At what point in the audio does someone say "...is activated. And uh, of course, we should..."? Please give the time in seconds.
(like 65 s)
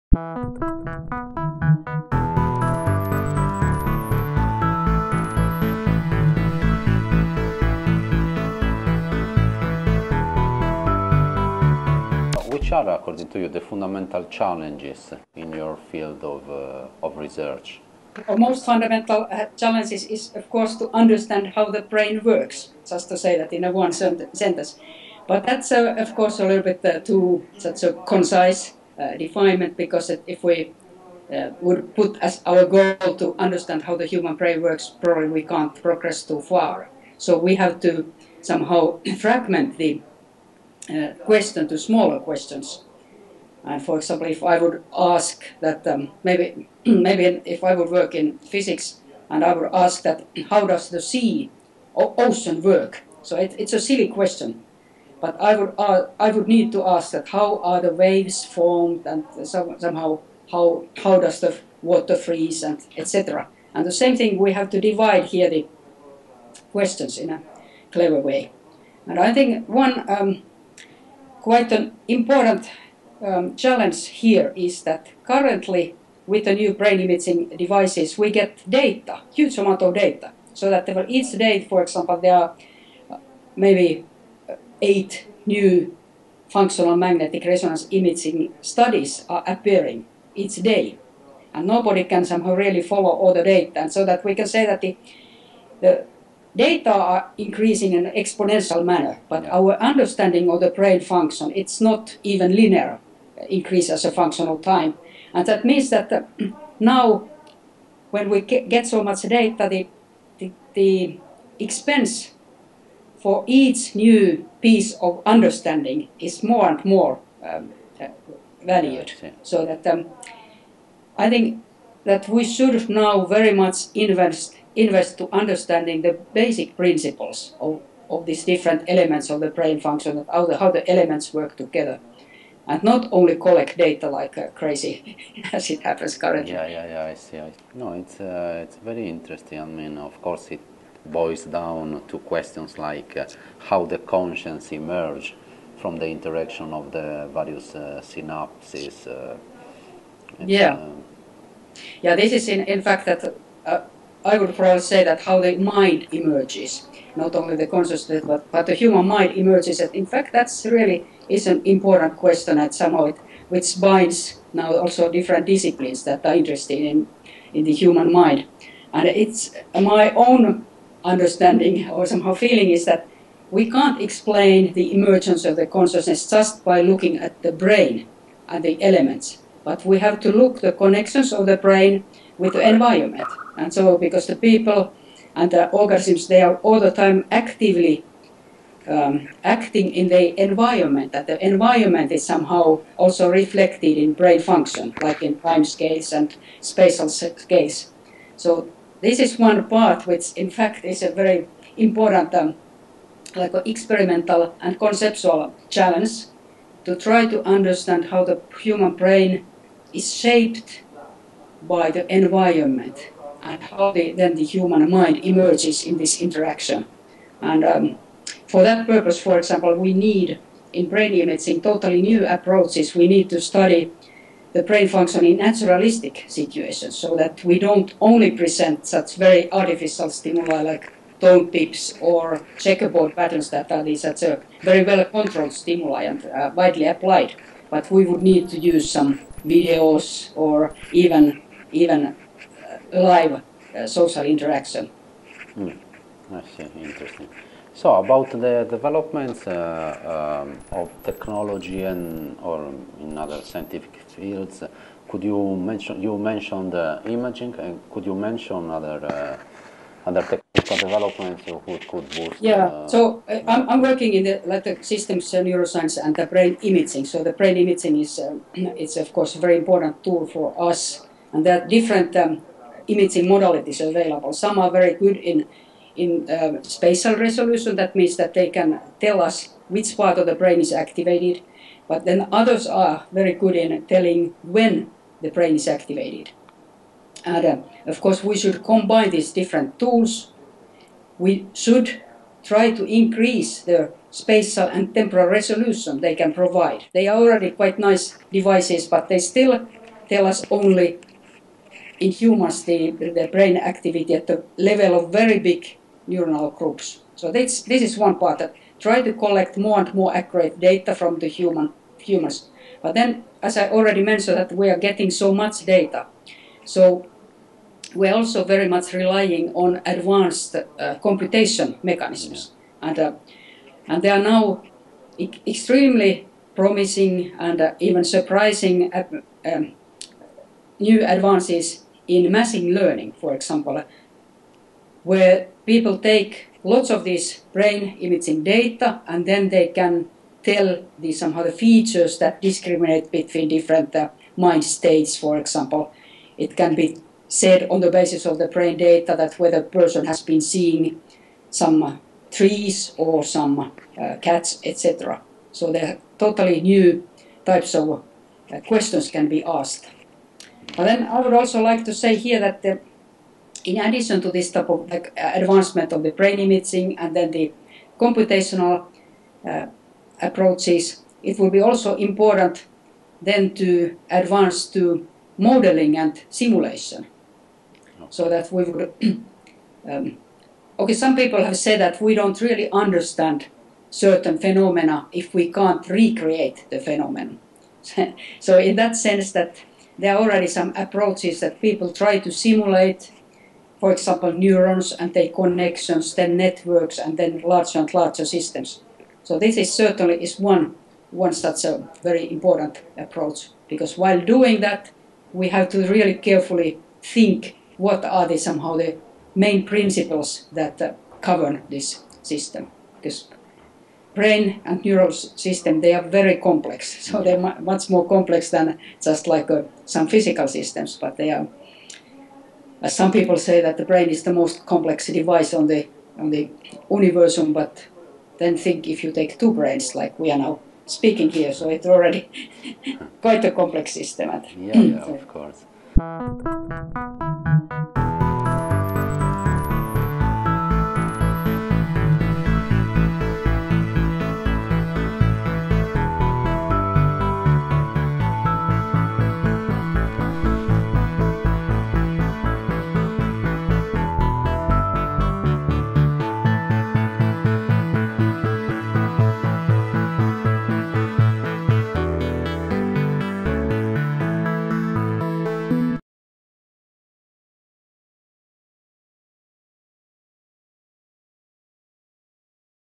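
285 s.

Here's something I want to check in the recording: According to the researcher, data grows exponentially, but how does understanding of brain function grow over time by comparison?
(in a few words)
not even linear.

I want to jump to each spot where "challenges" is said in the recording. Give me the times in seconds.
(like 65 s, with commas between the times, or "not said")
14 s, 19 s, 73 s, 205 s.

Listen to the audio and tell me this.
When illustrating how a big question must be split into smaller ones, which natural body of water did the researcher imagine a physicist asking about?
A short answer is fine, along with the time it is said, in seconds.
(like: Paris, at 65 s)
sea or ocean, at 51 s.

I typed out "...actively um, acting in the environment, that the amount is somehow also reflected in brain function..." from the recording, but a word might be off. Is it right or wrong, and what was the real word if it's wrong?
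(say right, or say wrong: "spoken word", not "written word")
wrong: "environment", not "amount".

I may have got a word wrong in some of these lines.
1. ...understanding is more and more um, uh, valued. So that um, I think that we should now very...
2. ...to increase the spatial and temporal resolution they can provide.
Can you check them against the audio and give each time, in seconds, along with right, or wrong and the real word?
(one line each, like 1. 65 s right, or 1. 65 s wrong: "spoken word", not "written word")
1. 115 s right
2. 292 s right.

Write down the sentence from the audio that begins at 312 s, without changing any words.
But then, as I already mentioned, that we are getting so much data.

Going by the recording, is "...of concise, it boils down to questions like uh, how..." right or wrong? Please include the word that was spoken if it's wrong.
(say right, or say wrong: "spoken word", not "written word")
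wrong: "course", not "concise".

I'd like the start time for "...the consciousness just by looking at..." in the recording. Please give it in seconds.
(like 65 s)
175 s.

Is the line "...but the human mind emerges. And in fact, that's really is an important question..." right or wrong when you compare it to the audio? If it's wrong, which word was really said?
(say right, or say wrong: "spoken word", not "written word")
right.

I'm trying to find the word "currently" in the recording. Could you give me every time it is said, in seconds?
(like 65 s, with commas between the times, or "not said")
75 s, 136 s.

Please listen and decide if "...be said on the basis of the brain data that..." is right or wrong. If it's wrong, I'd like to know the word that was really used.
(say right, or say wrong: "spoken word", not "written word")
right.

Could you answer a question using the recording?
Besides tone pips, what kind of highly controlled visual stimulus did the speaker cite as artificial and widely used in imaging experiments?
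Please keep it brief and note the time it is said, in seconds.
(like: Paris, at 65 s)
checkerboard patterns, at 232 s.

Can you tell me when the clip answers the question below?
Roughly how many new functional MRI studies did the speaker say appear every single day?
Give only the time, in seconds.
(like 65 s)
84 s.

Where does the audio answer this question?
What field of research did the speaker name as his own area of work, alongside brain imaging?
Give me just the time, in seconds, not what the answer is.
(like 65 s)
264 s.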